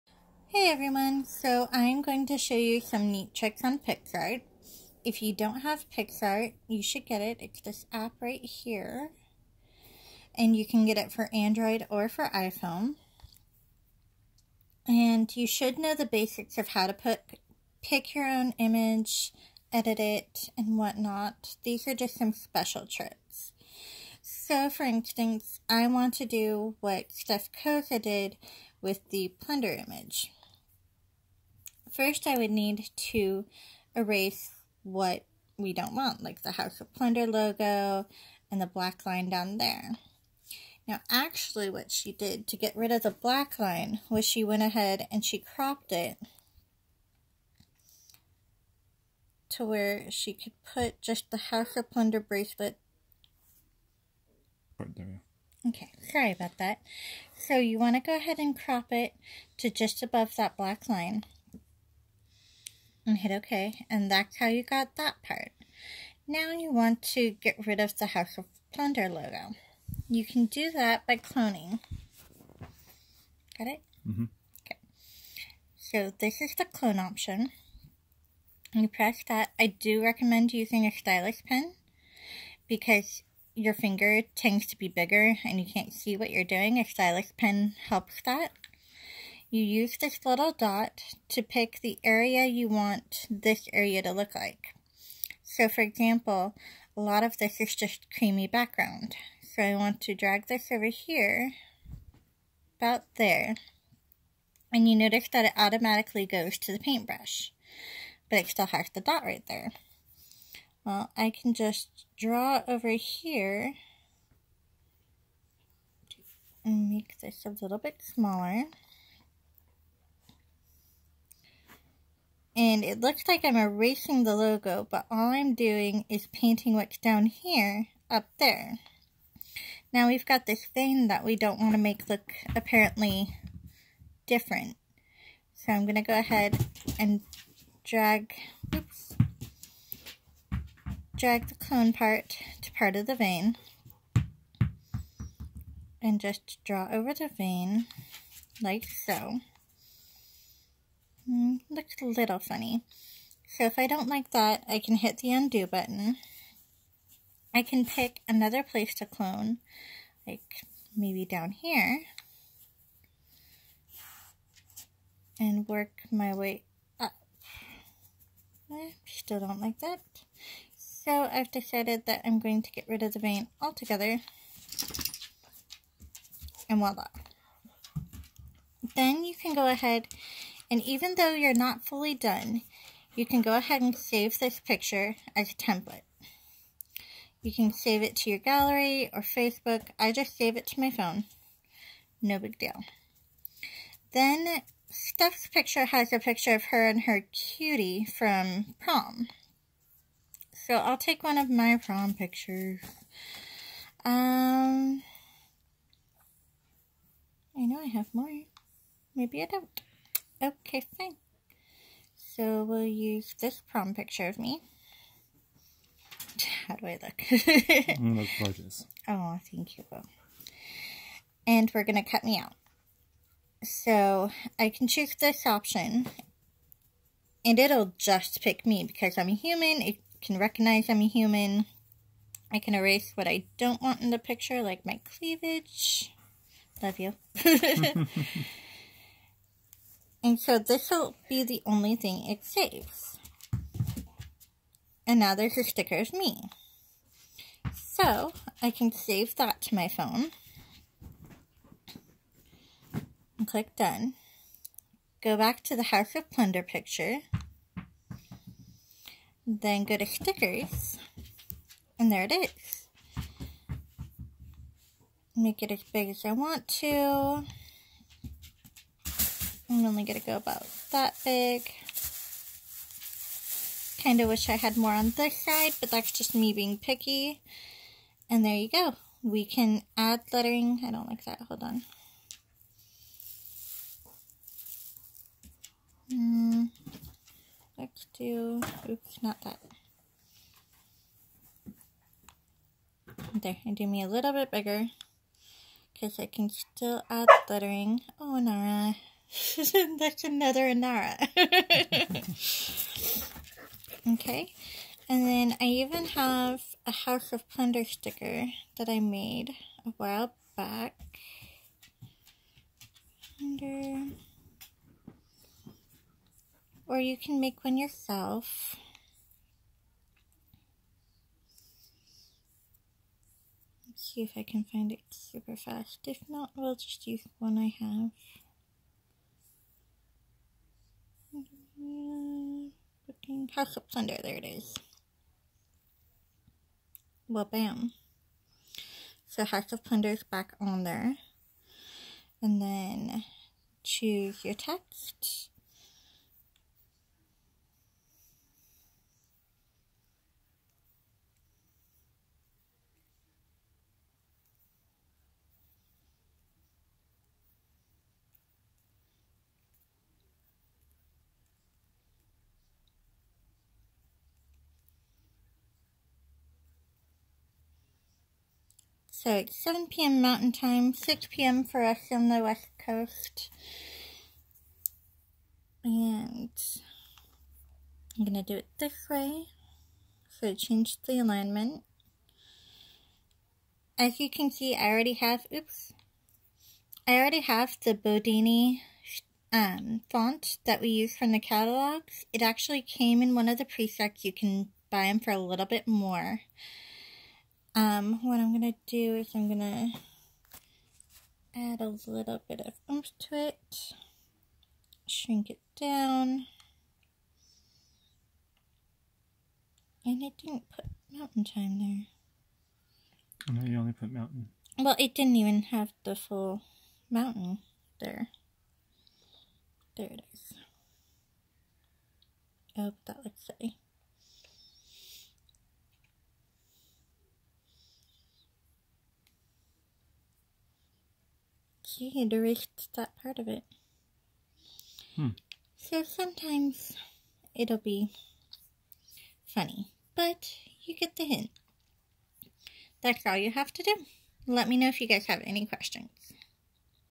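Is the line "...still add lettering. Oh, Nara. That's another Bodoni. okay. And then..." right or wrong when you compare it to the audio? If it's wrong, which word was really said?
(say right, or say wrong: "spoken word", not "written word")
wrong: "Inara", not "Bodoni".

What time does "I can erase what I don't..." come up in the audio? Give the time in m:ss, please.
3:52.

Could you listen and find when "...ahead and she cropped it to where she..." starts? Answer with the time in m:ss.
0:44.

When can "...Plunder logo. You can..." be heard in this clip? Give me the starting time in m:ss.
1:08.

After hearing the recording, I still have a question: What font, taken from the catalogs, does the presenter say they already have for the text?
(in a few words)
Bodoni.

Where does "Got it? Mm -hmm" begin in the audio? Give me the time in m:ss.
1:13.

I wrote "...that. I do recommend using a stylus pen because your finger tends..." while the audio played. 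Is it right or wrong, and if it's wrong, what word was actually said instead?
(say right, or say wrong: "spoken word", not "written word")
right.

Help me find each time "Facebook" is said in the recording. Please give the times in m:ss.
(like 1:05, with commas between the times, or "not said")
3:09.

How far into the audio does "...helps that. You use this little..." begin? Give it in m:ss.
1:27.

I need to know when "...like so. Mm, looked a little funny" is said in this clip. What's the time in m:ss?
2:28.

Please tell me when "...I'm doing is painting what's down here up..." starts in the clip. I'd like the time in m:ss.
2:05.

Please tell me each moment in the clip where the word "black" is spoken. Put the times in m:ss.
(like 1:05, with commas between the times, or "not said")
0:38, 0:43, 1:00.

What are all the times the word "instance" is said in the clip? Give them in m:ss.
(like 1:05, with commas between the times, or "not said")
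0:24.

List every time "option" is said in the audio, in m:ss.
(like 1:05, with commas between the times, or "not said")
1:17, 3:45.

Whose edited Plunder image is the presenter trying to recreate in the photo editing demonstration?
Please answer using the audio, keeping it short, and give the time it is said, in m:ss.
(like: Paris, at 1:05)
Steph Koza, at 0:27.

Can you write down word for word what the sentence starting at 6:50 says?
And it didn't put mountain time there.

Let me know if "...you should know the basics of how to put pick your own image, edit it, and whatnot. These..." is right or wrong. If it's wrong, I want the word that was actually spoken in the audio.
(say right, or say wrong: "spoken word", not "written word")
right.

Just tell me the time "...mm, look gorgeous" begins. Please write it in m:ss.
3:37.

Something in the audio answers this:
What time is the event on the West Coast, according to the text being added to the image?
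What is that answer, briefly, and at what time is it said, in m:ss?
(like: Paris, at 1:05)
6 p.m., at 6:10.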